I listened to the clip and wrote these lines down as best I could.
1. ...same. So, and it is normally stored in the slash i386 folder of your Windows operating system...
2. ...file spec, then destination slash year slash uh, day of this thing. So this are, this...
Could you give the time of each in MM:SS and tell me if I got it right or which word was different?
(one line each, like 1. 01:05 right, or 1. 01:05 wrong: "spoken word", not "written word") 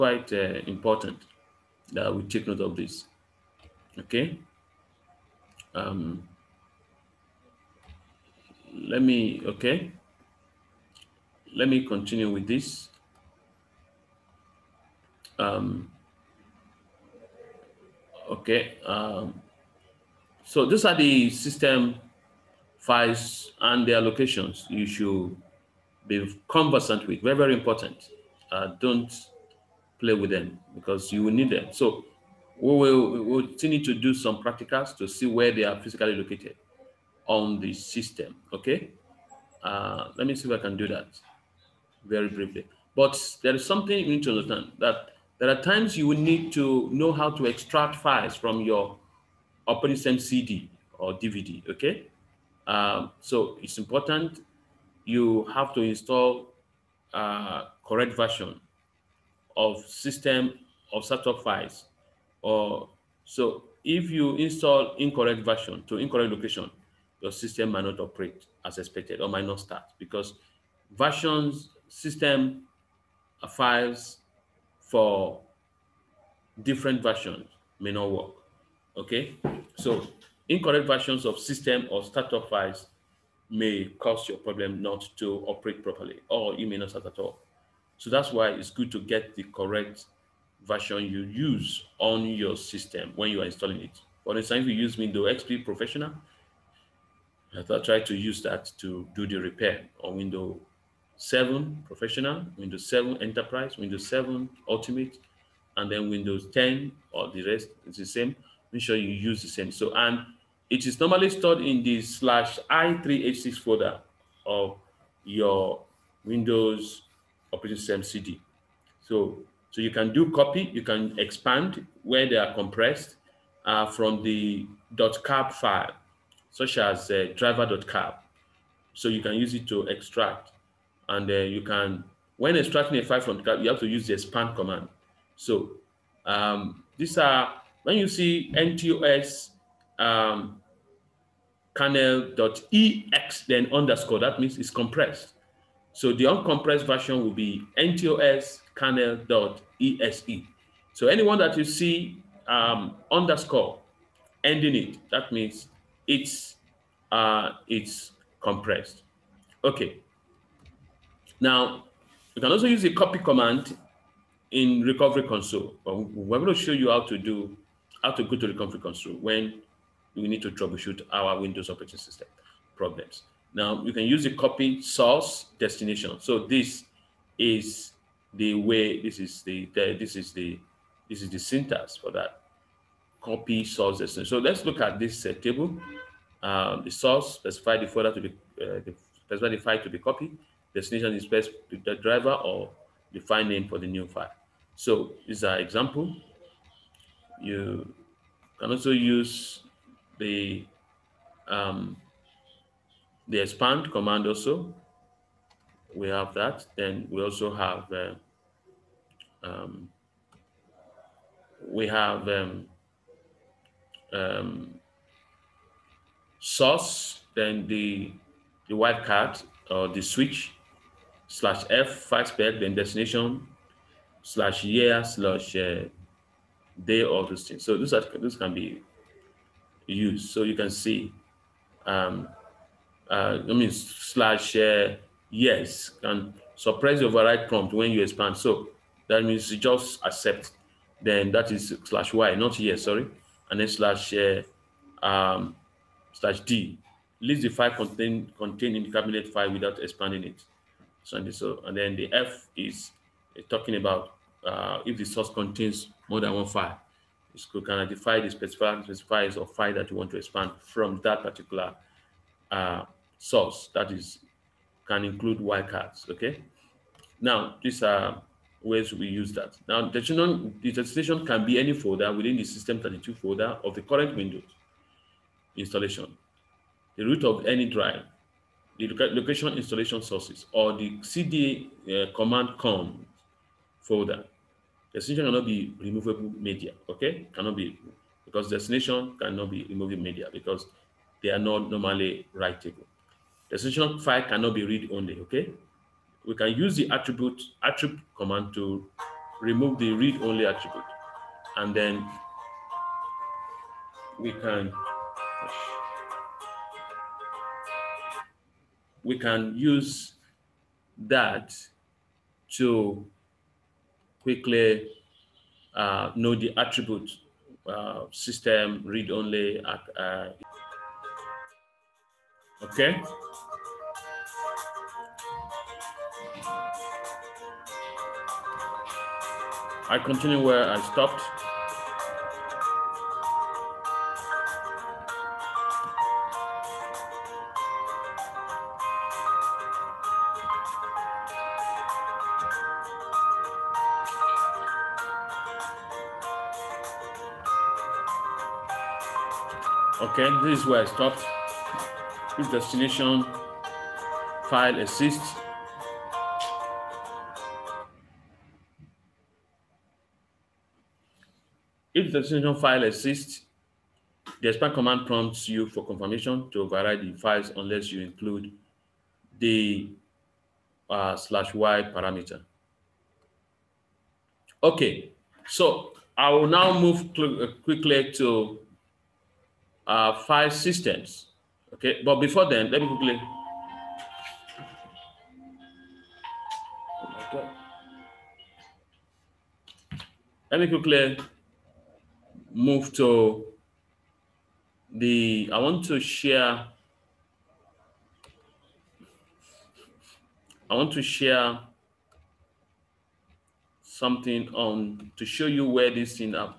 1. 01:49 right
2. 03:41 right.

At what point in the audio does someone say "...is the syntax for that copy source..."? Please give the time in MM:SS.
03:01.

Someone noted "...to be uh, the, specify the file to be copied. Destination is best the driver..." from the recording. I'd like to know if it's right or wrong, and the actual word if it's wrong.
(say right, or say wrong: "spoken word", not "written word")
right.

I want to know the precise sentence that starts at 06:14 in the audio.
Okay, so I will now move uh, quickly to uh, file systems.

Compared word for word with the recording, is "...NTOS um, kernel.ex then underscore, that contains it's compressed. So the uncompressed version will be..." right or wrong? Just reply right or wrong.
wrong.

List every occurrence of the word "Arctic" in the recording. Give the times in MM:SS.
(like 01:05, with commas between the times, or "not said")
not said.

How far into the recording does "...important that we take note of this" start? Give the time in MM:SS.
00:00.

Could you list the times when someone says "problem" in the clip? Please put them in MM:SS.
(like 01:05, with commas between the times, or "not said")
01:24, 02:52.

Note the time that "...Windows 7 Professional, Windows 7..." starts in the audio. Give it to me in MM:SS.
01:40.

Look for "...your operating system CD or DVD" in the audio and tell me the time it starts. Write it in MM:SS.
00:48.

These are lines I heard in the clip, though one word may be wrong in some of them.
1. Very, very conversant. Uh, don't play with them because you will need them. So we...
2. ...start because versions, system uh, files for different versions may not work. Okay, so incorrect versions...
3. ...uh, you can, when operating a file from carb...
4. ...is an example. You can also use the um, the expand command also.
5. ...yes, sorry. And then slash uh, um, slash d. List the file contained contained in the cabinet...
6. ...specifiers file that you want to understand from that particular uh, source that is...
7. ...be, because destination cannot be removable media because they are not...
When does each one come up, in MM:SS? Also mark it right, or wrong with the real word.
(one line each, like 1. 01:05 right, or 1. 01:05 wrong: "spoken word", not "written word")
1. 00:27 wrong: "important", not "conversant"
2. 01:09 right
3. 02:11 wrong: "extracting", not "operating"
4. 03:15 right
5. 04:02 right
6. 04:18 wrong: "expand", not "understand"
7. 04:47 right.